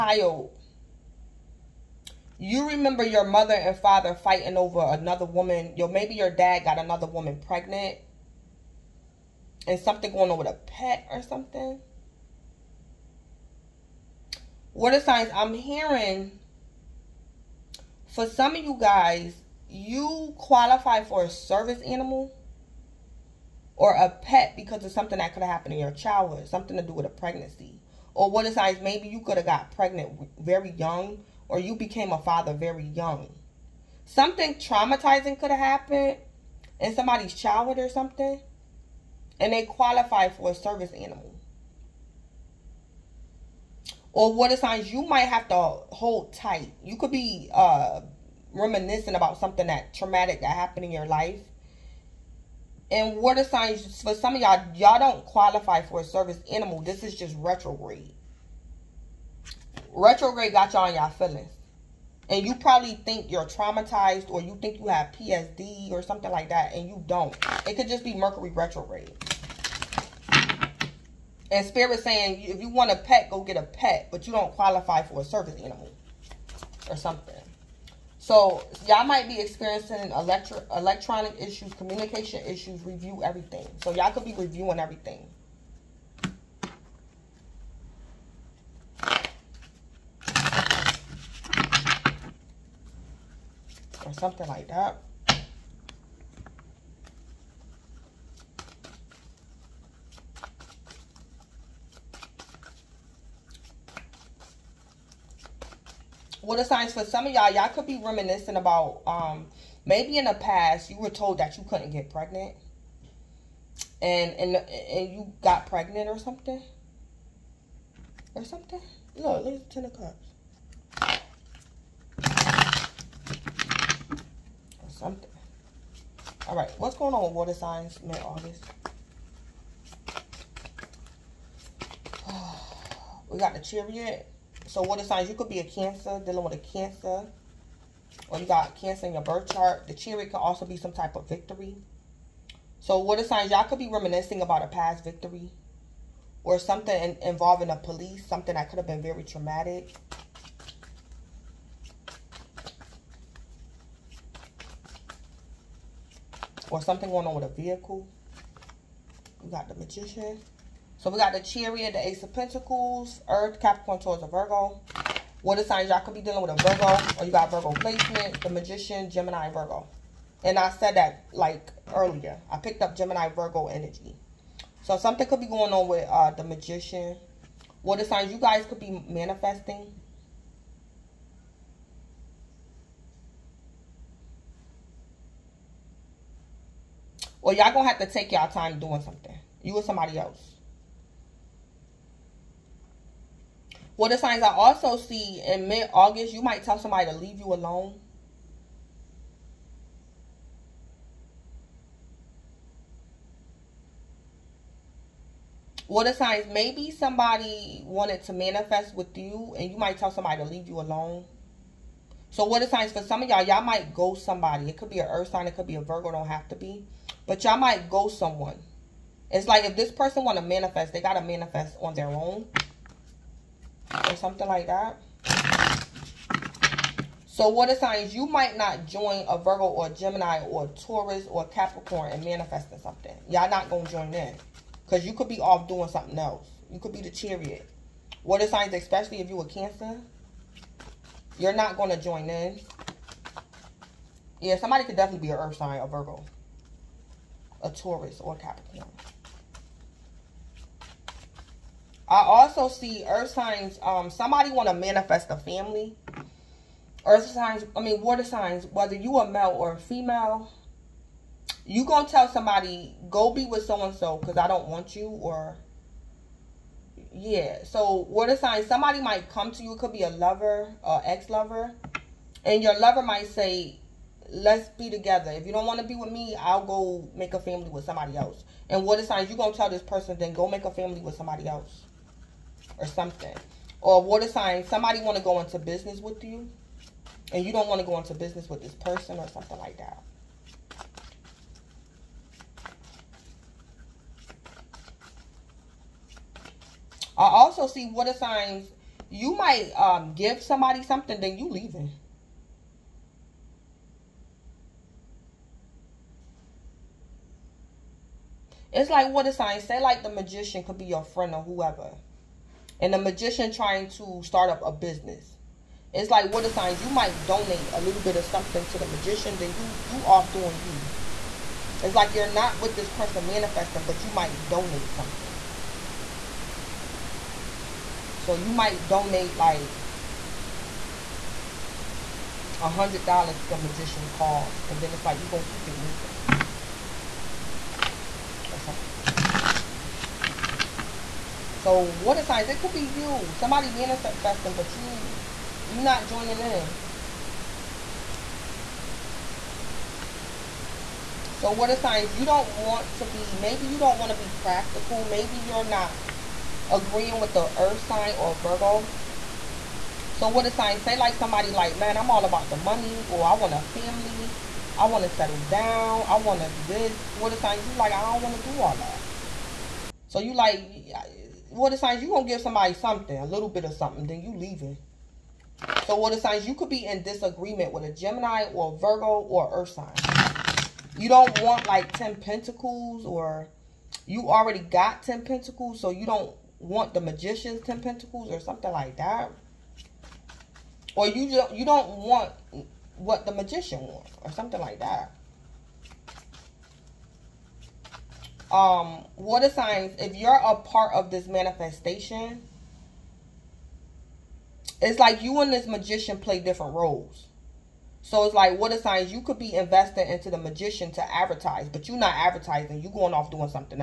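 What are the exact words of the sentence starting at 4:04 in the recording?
Yeah, somebody could definitely be an Earth sign or Virgo a Taurus or Capricorn.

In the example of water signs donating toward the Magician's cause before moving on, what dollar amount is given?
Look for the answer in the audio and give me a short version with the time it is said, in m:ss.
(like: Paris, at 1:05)
100 dollars, at 5:32.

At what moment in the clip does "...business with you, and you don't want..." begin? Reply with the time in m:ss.
4:45.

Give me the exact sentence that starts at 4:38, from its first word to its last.
And what a signs you gonna tell this person?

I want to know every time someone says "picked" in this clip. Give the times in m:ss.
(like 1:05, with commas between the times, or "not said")
2:52.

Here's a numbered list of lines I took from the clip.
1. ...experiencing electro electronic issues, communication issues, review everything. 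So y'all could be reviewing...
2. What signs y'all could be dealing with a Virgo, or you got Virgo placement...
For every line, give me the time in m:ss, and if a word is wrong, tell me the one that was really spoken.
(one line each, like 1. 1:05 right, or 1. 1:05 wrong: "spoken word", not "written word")
1. 1:19 right
2. 2:45 right.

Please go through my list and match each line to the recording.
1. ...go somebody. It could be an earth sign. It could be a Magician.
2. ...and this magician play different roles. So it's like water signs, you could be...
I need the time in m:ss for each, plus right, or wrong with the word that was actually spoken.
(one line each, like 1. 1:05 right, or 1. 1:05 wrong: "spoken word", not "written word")
1. 3:33 wrong: "Virgo", not "Magician"
2. 6:45 right.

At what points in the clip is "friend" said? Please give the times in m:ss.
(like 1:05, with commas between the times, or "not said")
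5:11.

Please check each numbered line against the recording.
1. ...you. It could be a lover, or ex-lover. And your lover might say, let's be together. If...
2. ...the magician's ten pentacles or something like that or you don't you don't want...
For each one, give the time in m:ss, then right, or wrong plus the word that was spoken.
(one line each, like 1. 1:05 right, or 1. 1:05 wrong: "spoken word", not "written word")
1. 4:29 right
2. 6:26 right.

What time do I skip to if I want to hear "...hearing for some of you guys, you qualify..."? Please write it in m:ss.
0:15.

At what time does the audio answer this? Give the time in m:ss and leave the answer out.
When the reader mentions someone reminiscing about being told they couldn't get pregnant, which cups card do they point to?
1:59.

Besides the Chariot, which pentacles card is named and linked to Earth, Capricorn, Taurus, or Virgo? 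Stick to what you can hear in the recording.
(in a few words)
Ace of Pentacles.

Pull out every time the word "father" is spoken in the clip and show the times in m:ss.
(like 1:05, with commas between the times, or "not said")
0:03, 0:32.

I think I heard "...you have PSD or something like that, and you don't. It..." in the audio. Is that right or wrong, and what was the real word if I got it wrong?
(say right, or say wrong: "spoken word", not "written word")
right.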